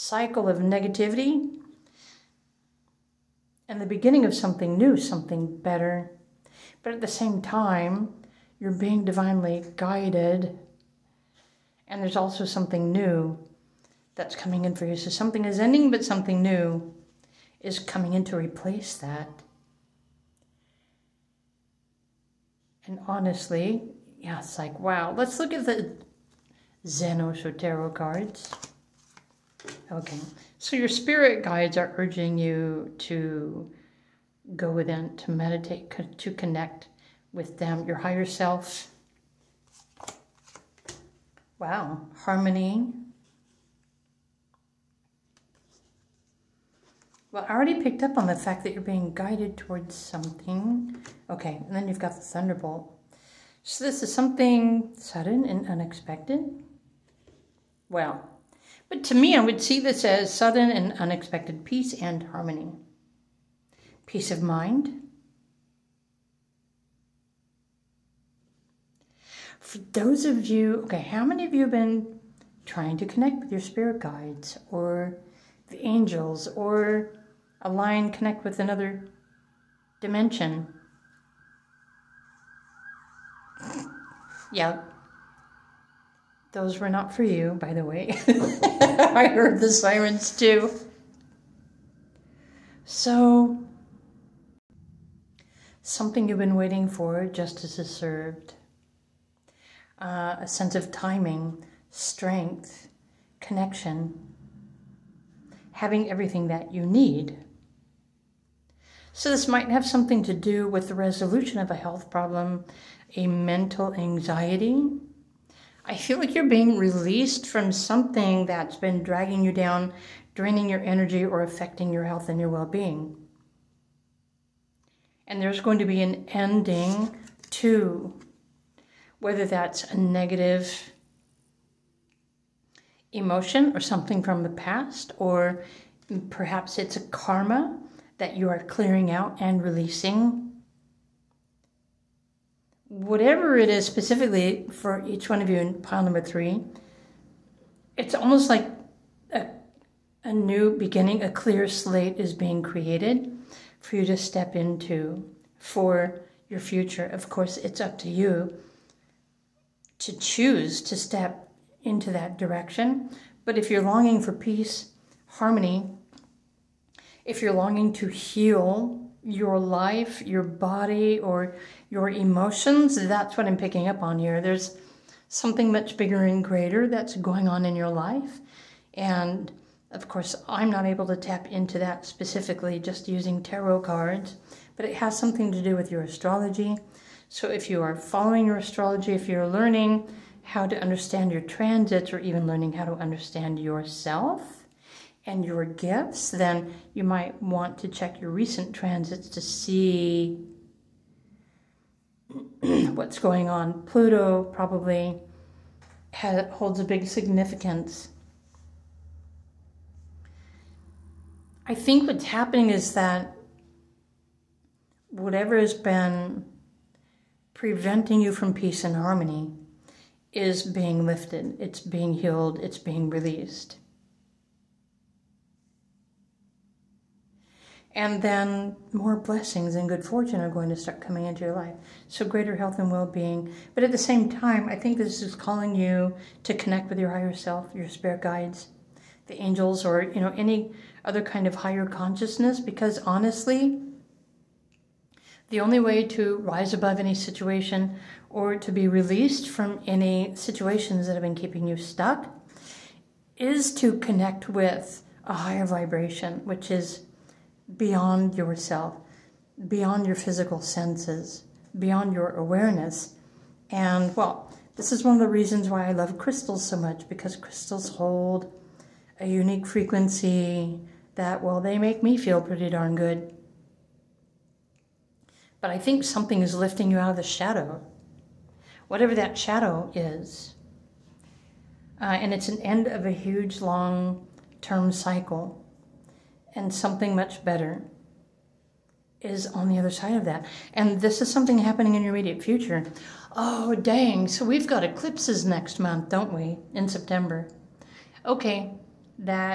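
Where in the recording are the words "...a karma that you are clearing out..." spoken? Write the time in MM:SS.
02:16.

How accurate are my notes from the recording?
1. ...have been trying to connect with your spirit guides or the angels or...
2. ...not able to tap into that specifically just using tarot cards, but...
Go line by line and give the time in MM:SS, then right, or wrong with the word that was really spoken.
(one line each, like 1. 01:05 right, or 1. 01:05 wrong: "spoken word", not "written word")
1. 01:11 right
2. 03:00 right.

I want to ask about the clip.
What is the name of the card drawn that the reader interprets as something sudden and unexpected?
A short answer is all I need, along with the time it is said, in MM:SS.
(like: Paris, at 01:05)
The Thunderbolt, at 00:52.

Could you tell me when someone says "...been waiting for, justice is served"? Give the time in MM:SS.
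01:36.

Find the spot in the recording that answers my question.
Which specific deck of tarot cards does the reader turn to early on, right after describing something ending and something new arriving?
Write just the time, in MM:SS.
00:26.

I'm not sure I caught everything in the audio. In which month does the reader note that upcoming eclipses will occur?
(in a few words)
September.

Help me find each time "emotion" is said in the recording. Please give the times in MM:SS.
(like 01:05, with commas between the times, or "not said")
02:13, 02:52.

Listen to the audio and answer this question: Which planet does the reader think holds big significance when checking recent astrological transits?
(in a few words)
Pluto.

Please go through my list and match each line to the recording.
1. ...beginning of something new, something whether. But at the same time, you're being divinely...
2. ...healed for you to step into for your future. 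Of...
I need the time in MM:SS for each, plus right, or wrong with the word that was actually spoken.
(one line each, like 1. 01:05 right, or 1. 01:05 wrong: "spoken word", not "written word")
1. 00:03 wrong: "better", not "whether"
2. 02:32 wrong: "created", not "healed".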